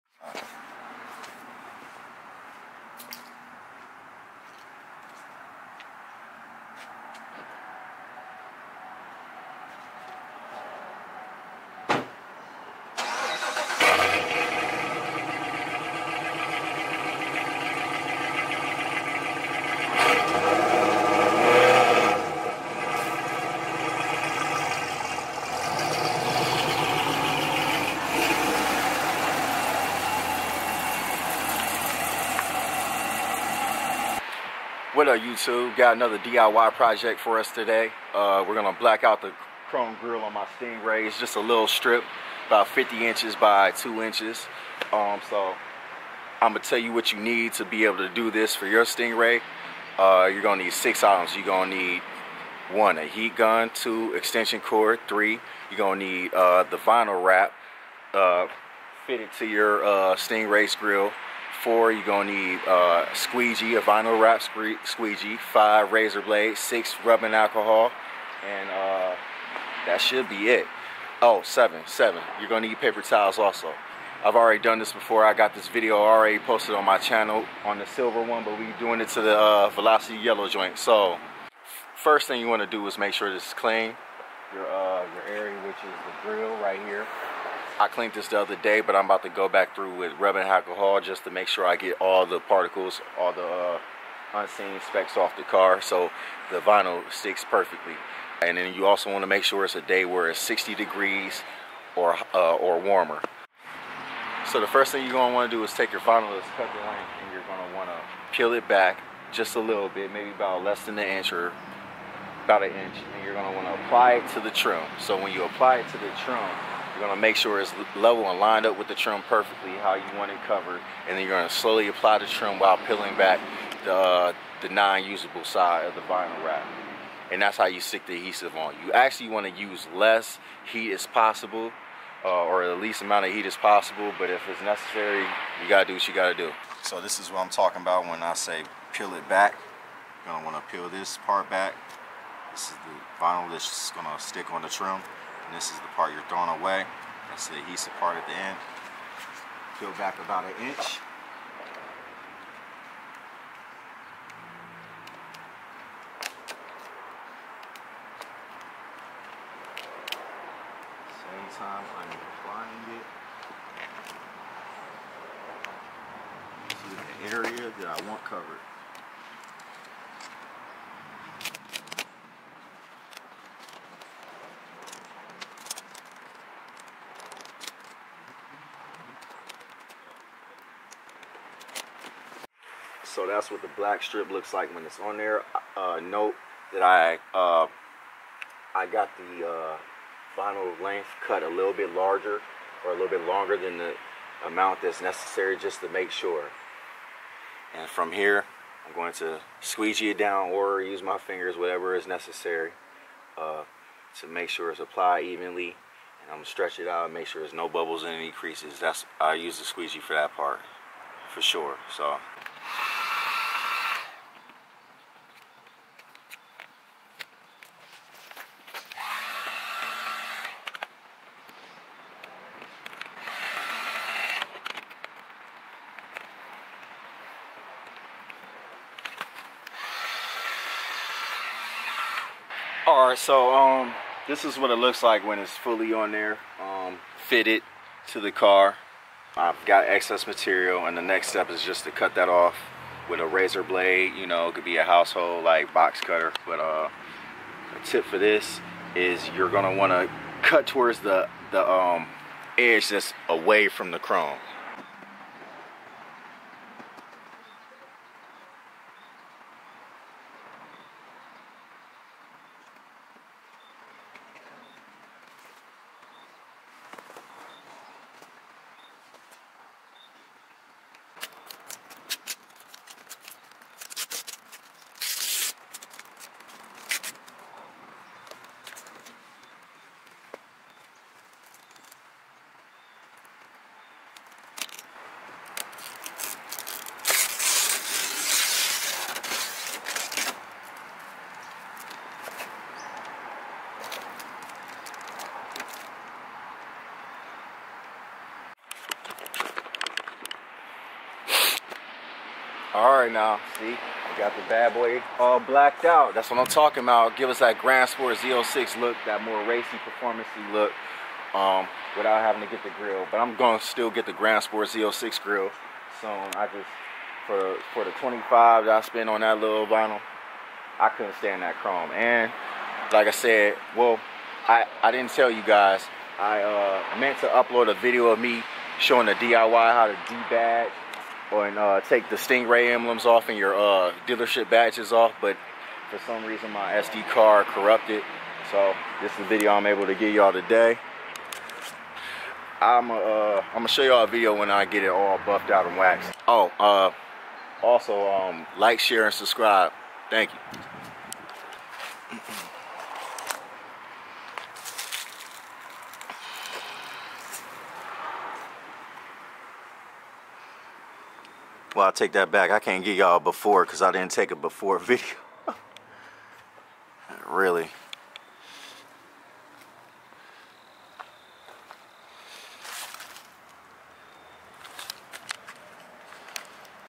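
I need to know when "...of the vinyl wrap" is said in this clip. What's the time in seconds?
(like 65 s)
125 s.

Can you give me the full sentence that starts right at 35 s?
Got another DIY project for us today.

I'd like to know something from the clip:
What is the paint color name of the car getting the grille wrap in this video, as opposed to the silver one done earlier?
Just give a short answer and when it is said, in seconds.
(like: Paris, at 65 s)
Velocity yellow, at 79 s.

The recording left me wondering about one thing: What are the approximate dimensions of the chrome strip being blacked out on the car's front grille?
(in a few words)
50 inches by 2 inches.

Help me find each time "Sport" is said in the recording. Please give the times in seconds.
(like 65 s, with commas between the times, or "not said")
307 s, 314 s.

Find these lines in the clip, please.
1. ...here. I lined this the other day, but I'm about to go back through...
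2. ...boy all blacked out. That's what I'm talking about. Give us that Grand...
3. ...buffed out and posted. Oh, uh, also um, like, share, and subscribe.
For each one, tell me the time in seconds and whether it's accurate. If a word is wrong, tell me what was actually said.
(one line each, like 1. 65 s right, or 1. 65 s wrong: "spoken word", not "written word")
1. 86 s wrong: "cleaned", not "lined"
2. 304 s right
3. 345 s wrong: "waxed", not "posted".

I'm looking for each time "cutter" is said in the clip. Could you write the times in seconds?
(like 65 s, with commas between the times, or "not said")
246 s.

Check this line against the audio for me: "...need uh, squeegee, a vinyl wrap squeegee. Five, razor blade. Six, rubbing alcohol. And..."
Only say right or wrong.
right.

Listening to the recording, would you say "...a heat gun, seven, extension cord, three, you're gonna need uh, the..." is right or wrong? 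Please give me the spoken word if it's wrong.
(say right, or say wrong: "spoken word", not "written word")
wrong: "two", not "seven".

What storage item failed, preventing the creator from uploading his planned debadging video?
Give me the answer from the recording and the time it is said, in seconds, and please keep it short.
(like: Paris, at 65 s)
SD card, at 336 s.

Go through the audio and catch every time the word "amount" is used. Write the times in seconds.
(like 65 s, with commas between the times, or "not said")
133 s, 194 s.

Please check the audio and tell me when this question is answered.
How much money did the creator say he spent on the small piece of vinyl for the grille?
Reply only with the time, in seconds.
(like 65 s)
317 s.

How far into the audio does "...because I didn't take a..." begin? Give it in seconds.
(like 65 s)
363 s.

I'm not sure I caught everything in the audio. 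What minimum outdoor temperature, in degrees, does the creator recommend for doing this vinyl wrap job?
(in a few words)
60 degrees.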